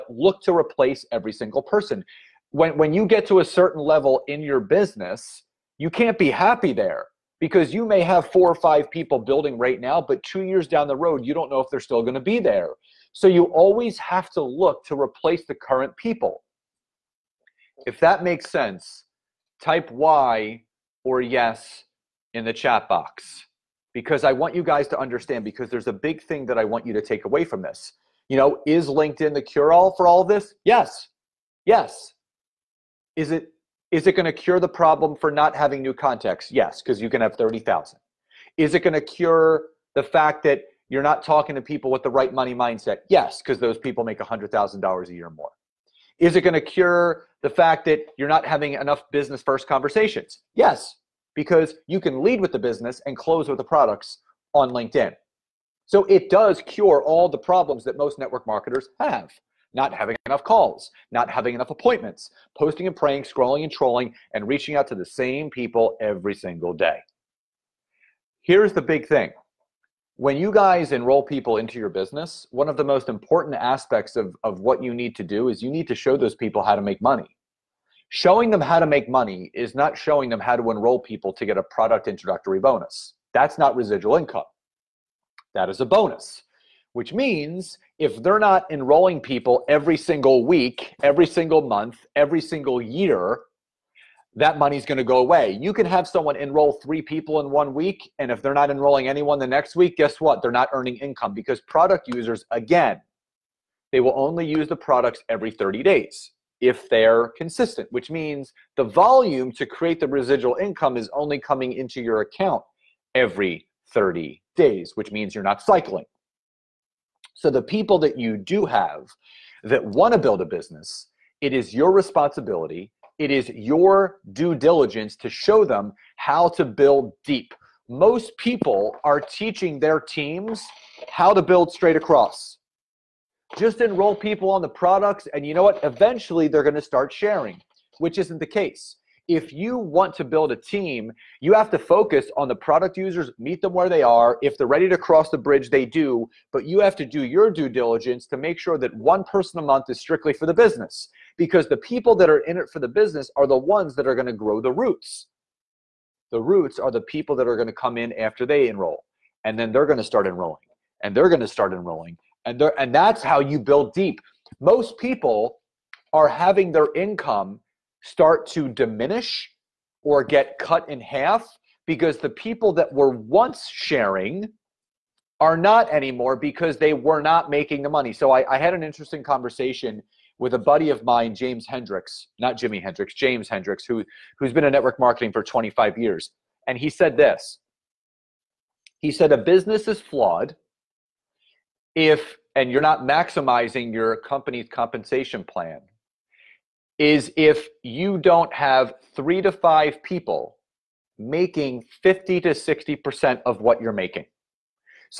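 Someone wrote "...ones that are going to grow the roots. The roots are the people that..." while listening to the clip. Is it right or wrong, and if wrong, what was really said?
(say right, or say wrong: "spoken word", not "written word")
right.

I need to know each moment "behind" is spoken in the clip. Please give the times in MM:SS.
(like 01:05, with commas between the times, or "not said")
not said.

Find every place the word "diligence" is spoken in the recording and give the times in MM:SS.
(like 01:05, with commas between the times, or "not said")
02:04, 02:27.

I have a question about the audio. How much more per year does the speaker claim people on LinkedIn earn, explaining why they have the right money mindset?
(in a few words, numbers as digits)
$100,000.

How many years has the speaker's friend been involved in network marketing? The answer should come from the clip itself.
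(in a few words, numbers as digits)
25 years.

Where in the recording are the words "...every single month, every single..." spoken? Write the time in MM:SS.
01:31.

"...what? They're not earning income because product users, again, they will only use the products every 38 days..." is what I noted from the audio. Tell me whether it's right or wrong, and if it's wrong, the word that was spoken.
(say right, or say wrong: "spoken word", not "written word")
wrong: "30", not "38".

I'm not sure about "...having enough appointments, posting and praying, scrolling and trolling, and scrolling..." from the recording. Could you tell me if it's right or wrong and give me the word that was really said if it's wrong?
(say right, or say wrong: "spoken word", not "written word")
wrong: "reaching", not "scrolling".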